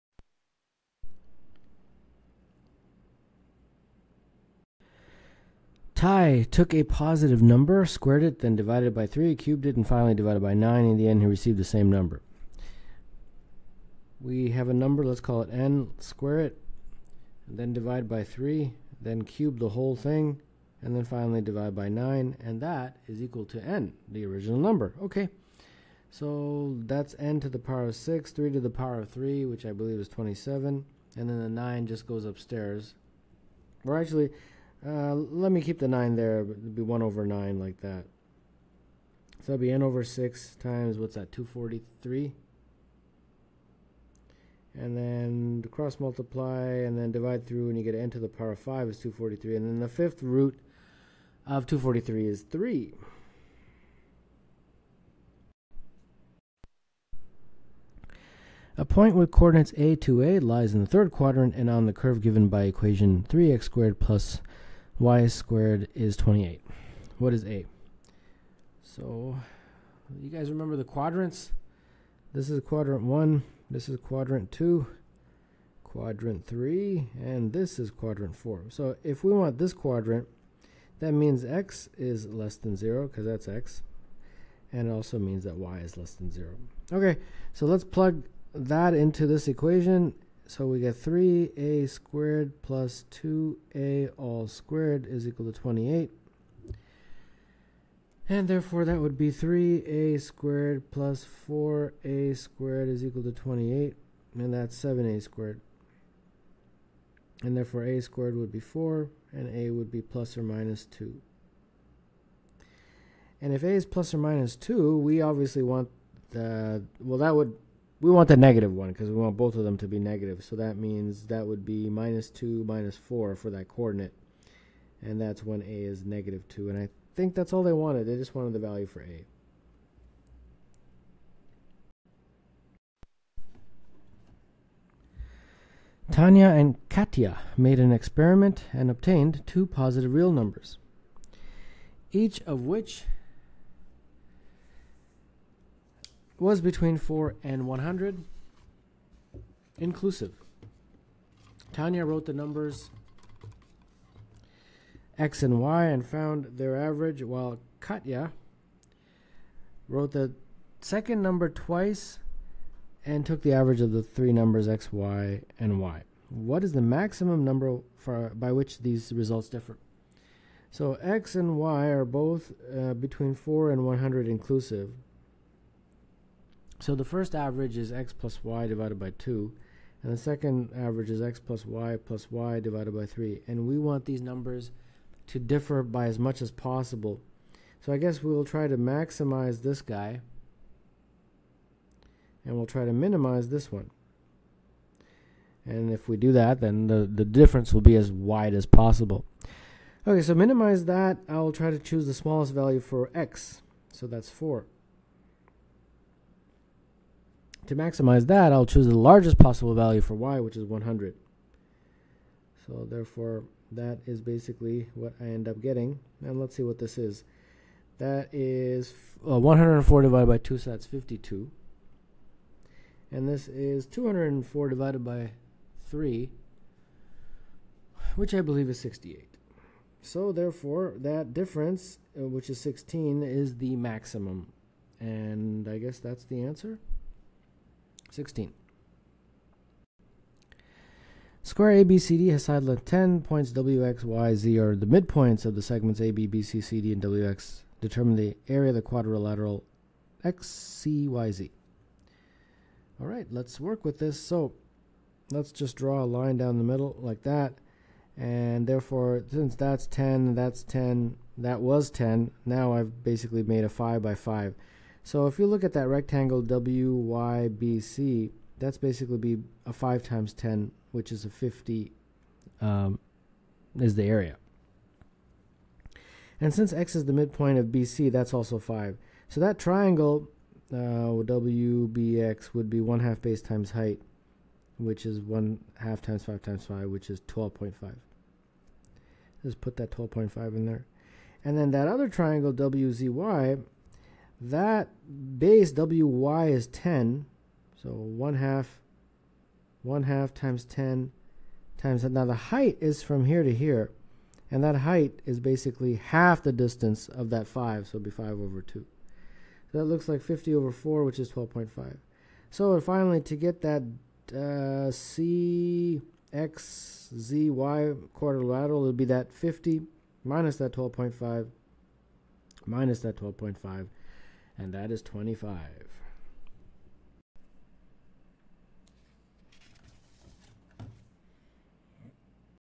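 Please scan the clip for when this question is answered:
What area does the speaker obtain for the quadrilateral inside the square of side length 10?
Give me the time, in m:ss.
5:25.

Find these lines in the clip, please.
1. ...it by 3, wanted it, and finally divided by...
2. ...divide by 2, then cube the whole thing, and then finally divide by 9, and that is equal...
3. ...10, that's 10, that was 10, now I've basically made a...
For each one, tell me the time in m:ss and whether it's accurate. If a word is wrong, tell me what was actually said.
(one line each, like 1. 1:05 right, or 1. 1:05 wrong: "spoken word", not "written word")
1. 0:08 wrong: "cubed", not "wanted"
2. 0:17 wrong: "3", not "2"
3. 4:19 right.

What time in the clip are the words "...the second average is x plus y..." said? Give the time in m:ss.
3:00.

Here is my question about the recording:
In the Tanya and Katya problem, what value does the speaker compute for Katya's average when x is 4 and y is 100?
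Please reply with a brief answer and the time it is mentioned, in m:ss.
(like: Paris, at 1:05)
68, at 3:48.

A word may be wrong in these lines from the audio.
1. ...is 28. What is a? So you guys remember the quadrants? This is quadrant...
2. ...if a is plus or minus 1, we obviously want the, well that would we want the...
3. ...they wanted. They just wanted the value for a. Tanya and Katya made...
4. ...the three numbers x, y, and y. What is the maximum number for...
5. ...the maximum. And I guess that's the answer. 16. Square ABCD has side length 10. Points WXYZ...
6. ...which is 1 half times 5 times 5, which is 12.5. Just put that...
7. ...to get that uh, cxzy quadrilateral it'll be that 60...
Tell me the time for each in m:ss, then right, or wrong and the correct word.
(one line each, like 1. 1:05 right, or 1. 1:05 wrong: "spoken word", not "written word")
1. 1:05 right
2. 1:53 wrong: "2", not "1"
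3. 2:07 right
4. 2:43 right
5. 3:53 right
6. 4:44 right
7. 5:13 wrong: "50", not "60".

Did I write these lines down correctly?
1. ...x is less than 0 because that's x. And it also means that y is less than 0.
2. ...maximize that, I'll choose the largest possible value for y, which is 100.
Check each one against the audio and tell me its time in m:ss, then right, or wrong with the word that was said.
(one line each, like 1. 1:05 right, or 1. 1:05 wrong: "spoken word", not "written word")
1. 1:21 right
2. 3:27 right.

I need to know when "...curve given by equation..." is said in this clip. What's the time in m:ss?
1:01.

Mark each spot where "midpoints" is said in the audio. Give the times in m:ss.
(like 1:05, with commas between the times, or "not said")
4:04, 4:37.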